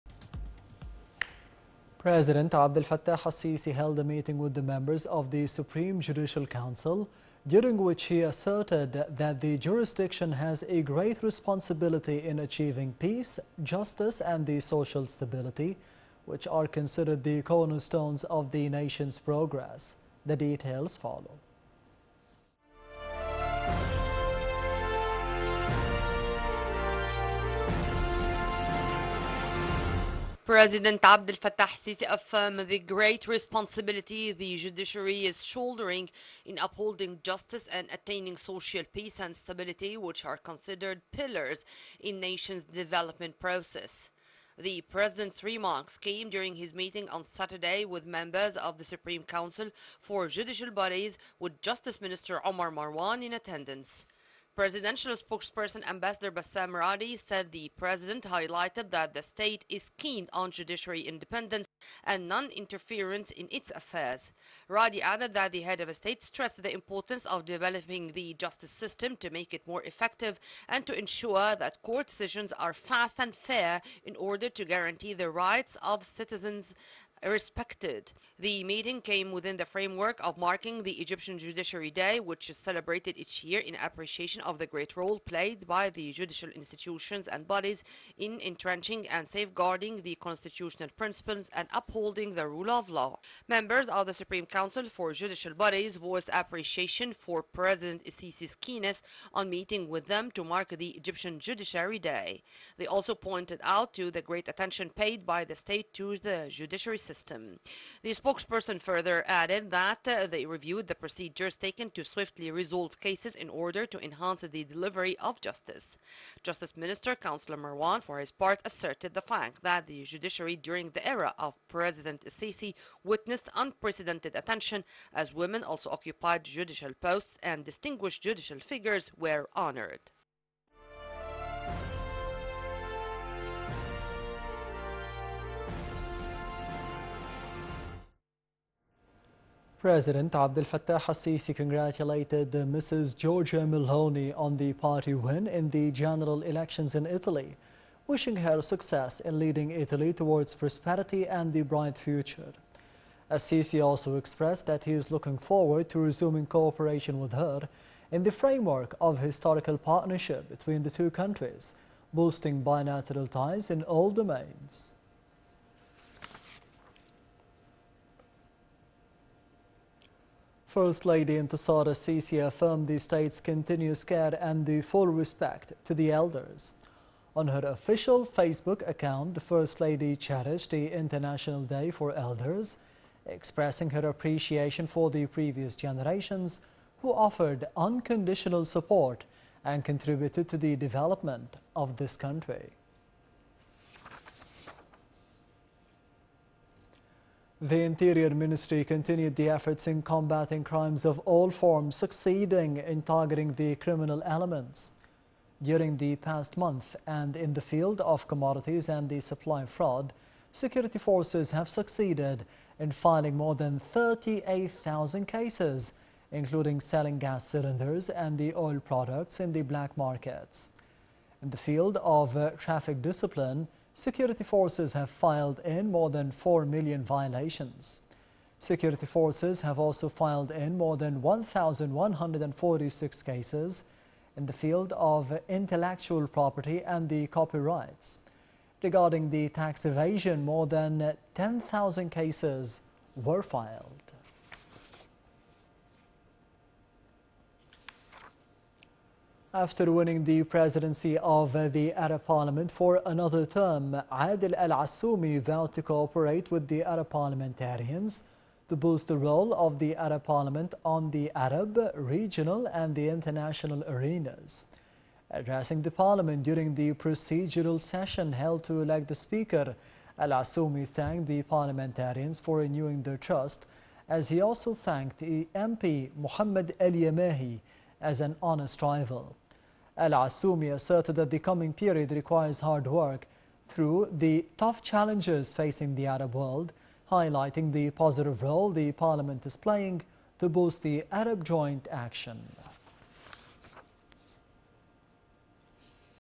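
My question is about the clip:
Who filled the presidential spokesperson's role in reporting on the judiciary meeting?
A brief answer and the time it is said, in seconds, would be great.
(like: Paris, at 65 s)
Bassam Radi, at 56 s.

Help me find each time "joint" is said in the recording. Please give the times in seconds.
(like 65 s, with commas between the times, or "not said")
291 s.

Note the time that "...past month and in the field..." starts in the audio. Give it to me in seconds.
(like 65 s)
206 s.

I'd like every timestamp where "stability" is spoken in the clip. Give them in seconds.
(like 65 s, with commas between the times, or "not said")
15 s, 39 s.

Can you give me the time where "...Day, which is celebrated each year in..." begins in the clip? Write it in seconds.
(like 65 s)
81 s.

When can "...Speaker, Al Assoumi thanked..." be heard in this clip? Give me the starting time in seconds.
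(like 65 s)
269 s.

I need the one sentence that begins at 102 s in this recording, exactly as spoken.
They also pointed out to the great attention paid by the state to the judiciary system system.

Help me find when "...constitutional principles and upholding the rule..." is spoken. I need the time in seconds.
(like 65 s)
90 s.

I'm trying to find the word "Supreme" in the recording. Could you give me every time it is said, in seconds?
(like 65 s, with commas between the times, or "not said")
5 s, 48 s, 94 s.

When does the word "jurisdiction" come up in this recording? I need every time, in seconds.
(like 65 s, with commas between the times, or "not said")
9 s.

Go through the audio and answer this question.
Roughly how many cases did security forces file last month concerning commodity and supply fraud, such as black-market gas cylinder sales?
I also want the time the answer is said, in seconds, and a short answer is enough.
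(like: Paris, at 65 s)
38,000, at 213 s.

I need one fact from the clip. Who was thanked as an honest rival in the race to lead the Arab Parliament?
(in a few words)
Mohammed El Yamahi.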